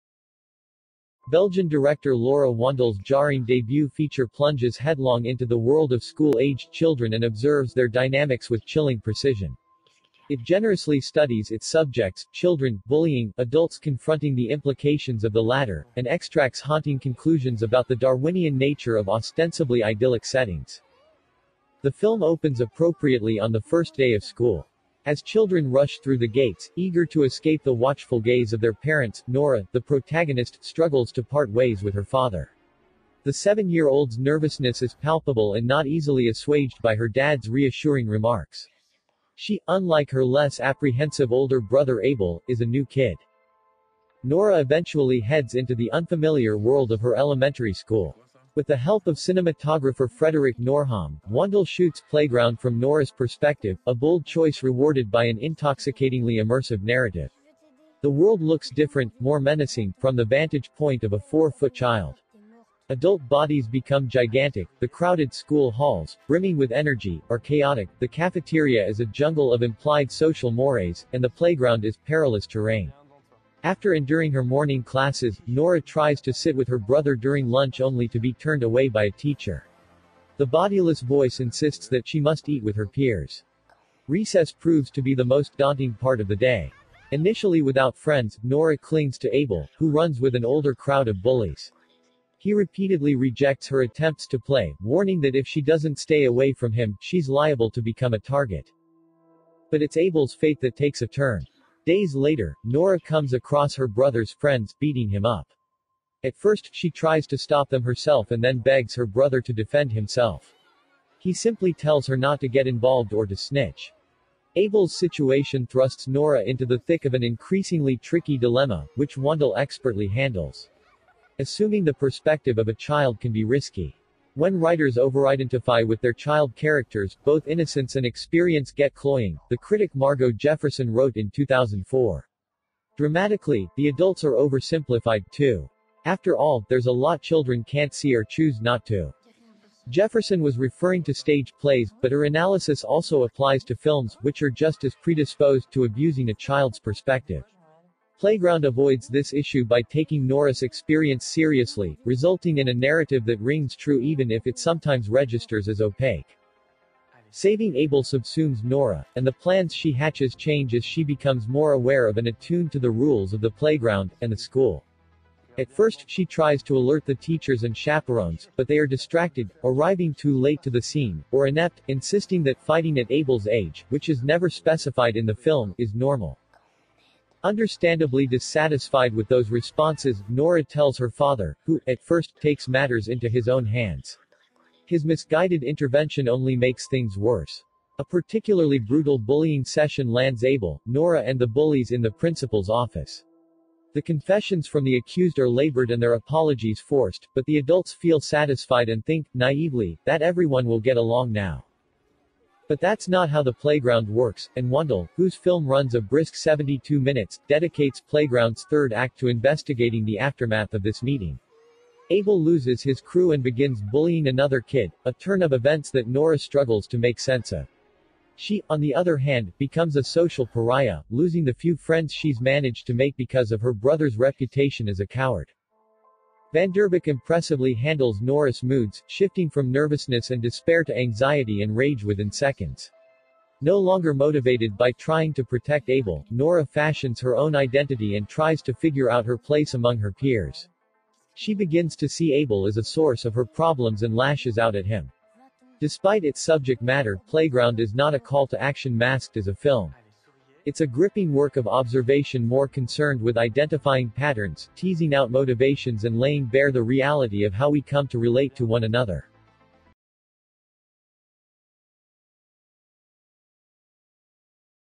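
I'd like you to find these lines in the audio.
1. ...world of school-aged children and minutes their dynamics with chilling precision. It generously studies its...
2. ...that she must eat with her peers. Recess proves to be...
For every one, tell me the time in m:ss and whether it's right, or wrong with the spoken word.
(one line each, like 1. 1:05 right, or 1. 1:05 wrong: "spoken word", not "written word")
1. 0:05 wrong: "observes", not "minutes"
2. 1:21 right.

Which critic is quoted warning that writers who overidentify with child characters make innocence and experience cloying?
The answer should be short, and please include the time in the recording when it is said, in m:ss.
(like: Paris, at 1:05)
Margo Jefferson, at 2:09.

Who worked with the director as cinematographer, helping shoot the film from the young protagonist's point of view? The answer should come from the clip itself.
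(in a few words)
Frederick Noirhomme.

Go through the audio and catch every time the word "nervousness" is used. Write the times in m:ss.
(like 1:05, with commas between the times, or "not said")
0:34, 3:49.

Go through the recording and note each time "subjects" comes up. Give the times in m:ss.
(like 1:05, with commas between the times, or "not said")
0:11, 4:06.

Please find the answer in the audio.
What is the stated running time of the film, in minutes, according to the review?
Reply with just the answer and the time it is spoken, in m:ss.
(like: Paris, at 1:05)
72 minutes, at 3:26.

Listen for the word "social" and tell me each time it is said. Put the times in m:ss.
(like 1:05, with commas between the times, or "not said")
1:10, 3:40.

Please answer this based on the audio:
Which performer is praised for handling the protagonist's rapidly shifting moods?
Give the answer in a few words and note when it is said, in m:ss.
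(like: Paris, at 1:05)
Van Vanderbeque, at 3:46.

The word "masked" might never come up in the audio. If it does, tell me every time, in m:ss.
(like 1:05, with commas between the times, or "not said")
4:08.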